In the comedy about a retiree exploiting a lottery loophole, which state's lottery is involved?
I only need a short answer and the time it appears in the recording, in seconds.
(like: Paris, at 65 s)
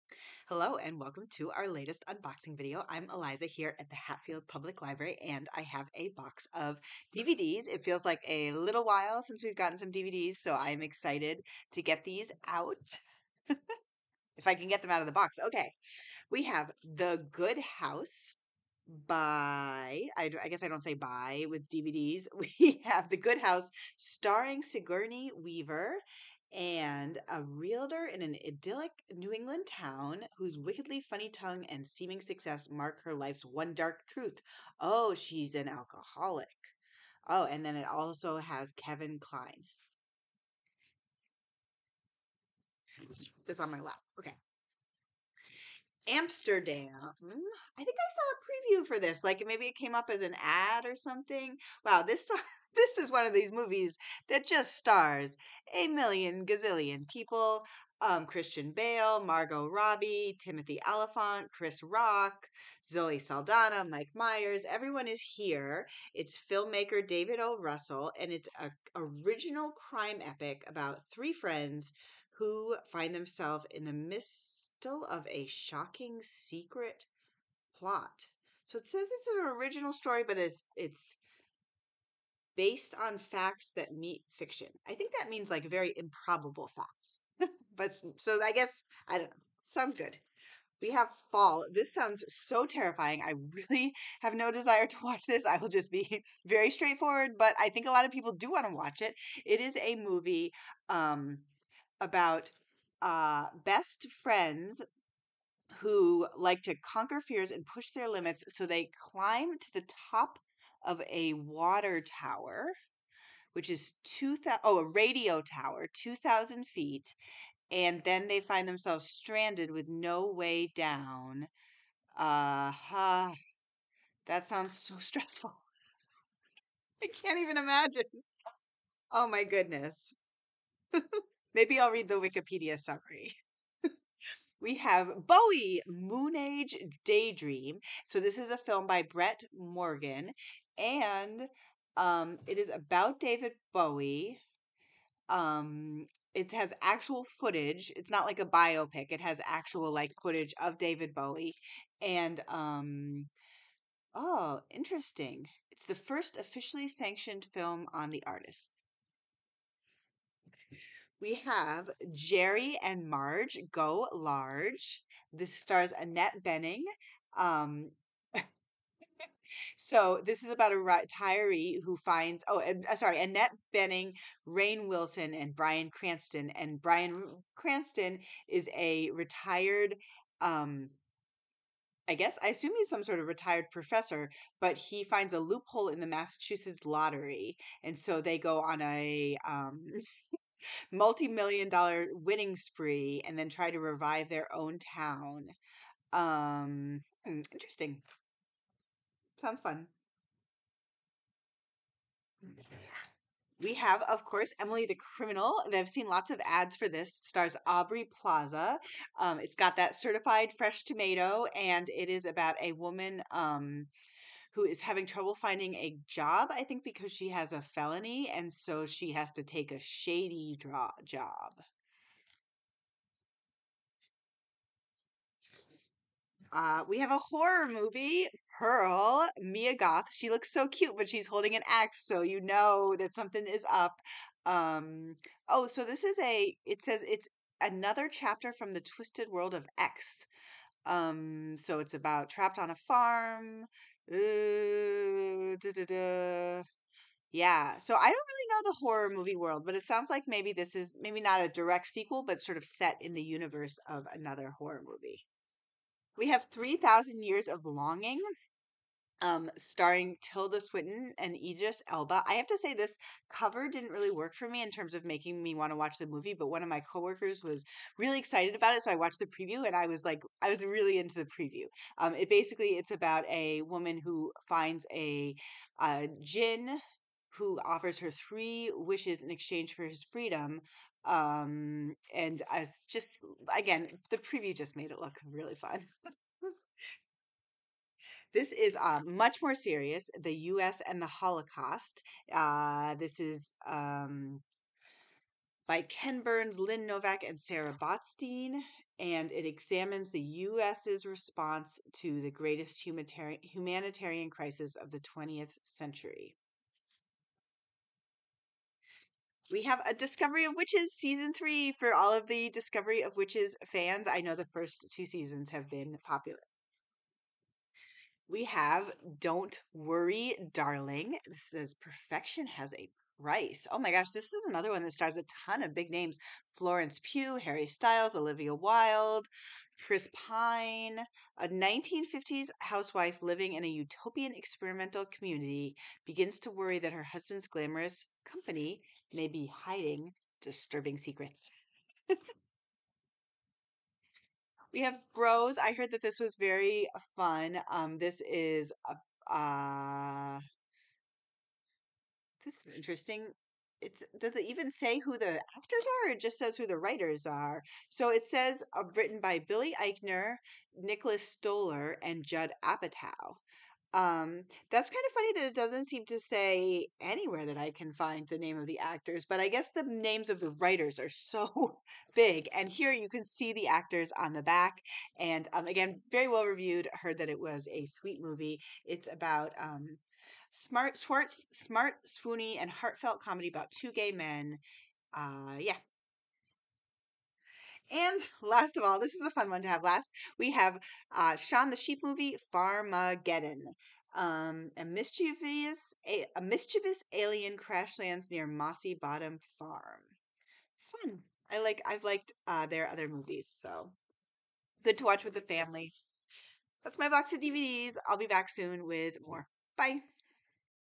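Massachusetts, at 186 s.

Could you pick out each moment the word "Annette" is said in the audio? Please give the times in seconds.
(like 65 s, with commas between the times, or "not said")
165 s, 173 s.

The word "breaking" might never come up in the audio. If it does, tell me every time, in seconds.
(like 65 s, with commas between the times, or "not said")
not said.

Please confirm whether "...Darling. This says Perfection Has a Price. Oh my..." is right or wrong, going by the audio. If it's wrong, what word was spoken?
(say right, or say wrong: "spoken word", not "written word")
right.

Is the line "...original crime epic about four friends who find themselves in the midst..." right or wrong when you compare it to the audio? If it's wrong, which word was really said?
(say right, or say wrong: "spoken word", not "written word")
wrong: "three", not "four".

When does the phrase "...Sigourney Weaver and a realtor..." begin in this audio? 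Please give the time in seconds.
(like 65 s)
24 s.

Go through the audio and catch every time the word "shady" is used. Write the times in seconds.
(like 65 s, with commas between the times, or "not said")
219 s.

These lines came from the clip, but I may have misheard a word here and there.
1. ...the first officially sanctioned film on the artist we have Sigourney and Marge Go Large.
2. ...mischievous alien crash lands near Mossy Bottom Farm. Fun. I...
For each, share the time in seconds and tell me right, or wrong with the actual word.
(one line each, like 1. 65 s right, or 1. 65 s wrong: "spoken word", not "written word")
1. 155 s wrong: "Jerry", not "Sigourney"
2. 396 s right.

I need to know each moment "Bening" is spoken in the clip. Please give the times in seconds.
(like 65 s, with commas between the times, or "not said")
166 s, 173 s.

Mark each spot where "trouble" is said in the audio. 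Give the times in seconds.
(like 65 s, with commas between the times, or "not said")
215 s.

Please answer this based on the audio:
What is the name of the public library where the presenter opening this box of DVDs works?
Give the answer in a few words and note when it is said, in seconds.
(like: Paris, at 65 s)
Hatfield Public Library, at 3 s.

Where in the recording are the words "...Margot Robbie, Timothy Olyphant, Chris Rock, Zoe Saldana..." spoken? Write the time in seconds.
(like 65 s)
59 s.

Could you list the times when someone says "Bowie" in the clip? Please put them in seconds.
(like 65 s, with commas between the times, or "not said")
135 s, 143 s, 151 s.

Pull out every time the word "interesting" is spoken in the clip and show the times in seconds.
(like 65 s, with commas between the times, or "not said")
154 s, 197 s, 352 s.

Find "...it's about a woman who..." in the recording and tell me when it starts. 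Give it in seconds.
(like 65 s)
272 s.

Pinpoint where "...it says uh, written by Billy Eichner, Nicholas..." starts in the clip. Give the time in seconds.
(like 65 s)
358 s.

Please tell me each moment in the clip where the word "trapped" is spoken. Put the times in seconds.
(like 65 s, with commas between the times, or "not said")
242 s.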